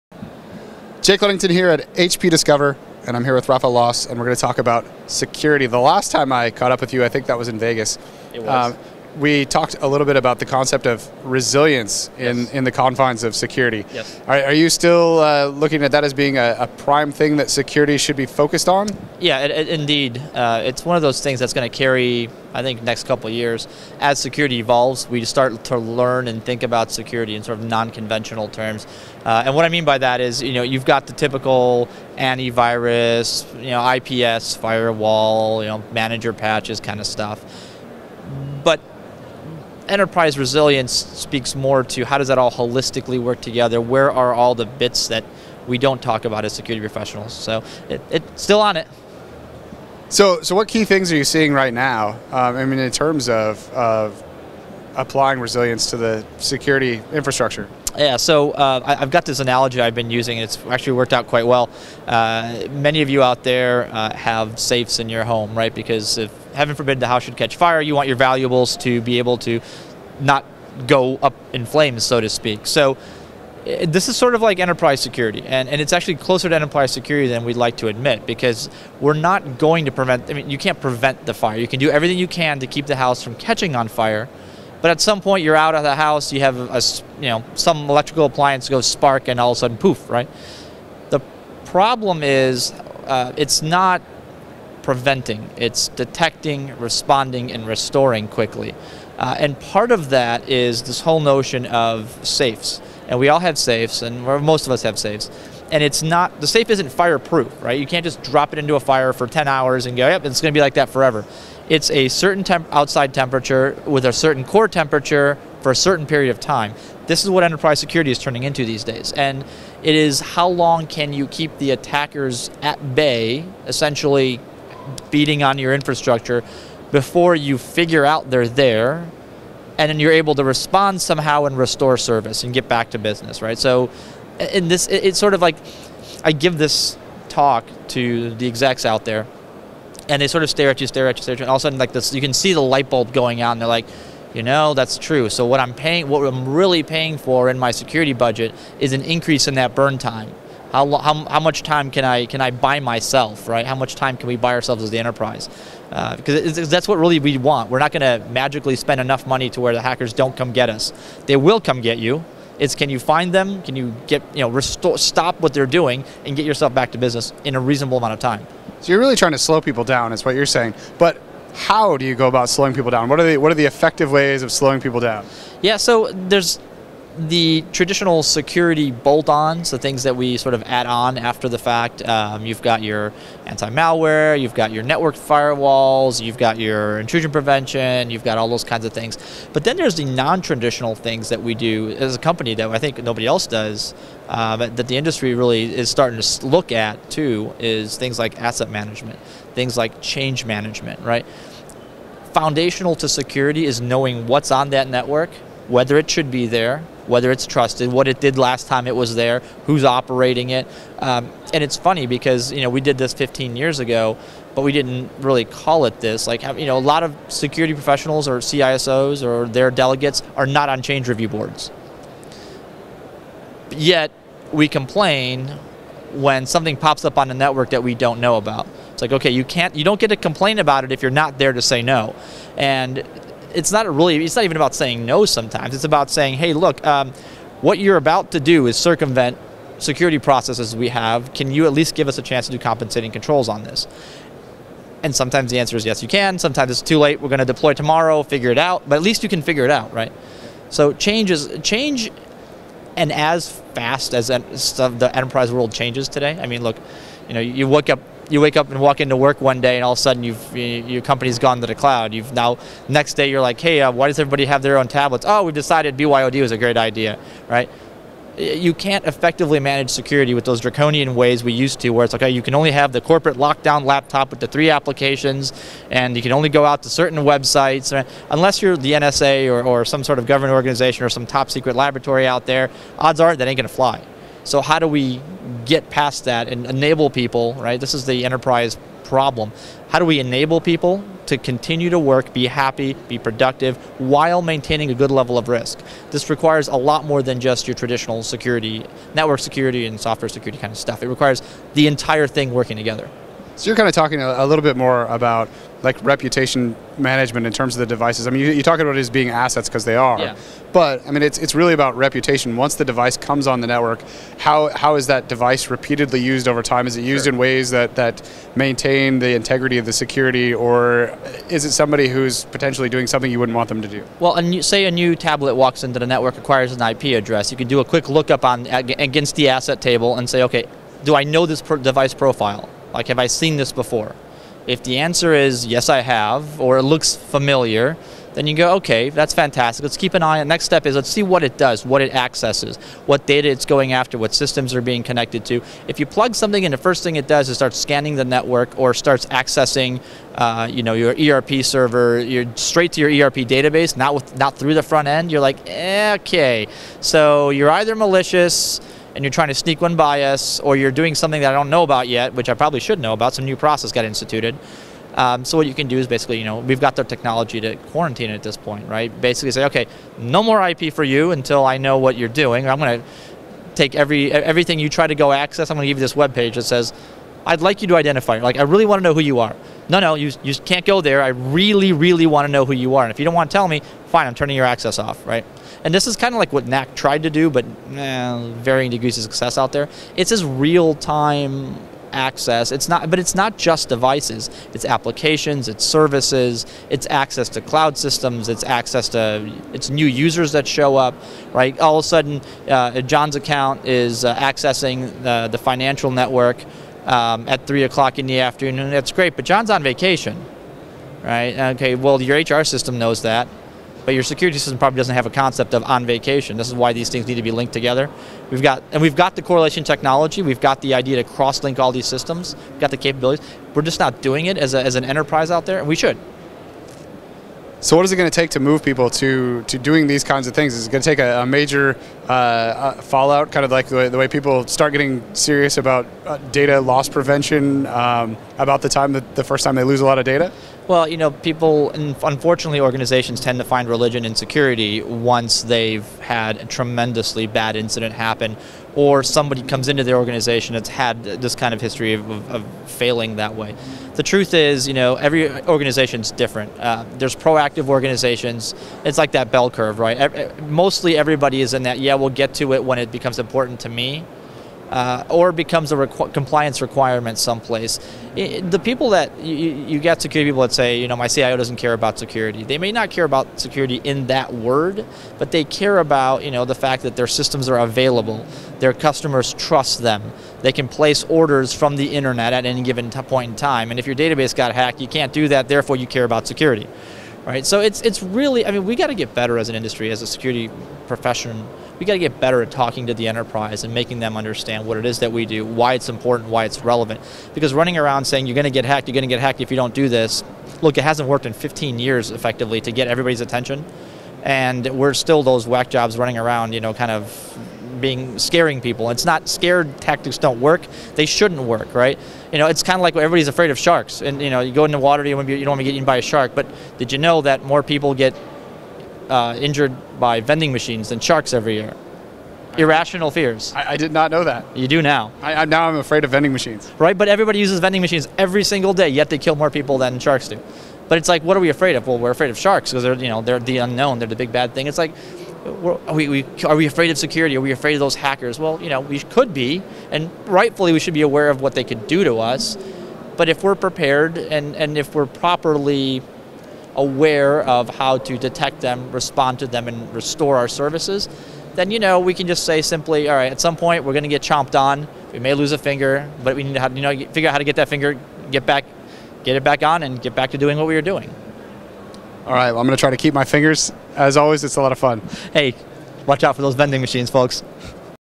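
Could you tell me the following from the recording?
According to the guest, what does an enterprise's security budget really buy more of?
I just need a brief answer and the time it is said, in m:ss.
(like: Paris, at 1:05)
Burn time, at 2:29.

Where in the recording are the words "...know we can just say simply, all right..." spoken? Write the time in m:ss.
9:11.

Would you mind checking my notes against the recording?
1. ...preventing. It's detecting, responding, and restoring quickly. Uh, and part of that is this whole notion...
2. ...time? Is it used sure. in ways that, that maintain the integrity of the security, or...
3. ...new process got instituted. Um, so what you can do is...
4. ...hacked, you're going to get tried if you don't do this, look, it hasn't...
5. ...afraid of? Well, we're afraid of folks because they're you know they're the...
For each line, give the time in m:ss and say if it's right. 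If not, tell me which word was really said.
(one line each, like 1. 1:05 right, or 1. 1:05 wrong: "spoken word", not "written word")
1. 1:34 right
2. 5:16 right
3. 6:03 right
4. 8:18 wrong: "hacked", not "tried"
5. 8:51 wrong: "sharks", not "folks".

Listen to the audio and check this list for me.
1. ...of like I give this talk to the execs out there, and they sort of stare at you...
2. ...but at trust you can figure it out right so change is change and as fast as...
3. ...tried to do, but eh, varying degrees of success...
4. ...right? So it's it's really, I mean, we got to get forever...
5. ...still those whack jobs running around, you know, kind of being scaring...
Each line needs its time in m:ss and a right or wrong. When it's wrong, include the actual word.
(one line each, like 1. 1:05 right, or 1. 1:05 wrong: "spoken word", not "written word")
1. 2:15 right
2. 4:08 wrong: "least", not "trust"
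3. 6:26 right
4. 8:07 wrong: "better", not "forever"
5. 8:25 right.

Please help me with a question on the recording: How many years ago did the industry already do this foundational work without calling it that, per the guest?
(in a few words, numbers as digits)
15 years.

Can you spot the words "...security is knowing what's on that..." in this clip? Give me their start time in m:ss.
3:23.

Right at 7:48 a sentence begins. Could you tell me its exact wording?
It, the people that you, you get security people that say, you know, my CIO doesn't care about security.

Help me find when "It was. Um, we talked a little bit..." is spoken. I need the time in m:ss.
0:08.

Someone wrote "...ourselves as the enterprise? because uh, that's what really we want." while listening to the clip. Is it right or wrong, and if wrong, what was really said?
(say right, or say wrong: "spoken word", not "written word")
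right.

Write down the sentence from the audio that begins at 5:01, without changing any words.
It requires the entire thing working together.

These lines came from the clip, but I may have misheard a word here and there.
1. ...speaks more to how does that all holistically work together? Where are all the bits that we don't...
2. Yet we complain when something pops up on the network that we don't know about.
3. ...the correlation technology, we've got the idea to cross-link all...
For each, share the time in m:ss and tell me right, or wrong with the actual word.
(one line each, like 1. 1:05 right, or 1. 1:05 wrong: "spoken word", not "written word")
1. 0:40 right
2. 3:43 right
3. 6:59 right.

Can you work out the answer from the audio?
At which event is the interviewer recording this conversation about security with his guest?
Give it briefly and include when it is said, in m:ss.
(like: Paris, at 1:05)
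HP Discover, at 0:01.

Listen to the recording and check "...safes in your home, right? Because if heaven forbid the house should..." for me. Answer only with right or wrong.
right.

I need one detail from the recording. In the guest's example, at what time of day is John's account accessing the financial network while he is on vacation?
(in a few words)
3 o'clock in the afternoon.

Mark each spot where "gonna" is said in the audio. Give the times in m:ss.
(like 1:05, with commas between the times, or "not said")
4:43.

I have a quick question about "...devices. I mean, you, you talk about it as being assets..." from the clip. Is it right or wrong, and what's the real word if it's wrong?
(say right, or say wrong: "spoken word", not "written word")
right.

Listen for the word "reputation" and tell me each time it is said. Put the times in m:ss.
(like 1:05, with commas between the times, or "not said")
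5:06, 5:11.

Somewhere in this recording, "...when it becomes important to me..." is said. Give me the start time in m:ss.
7:42.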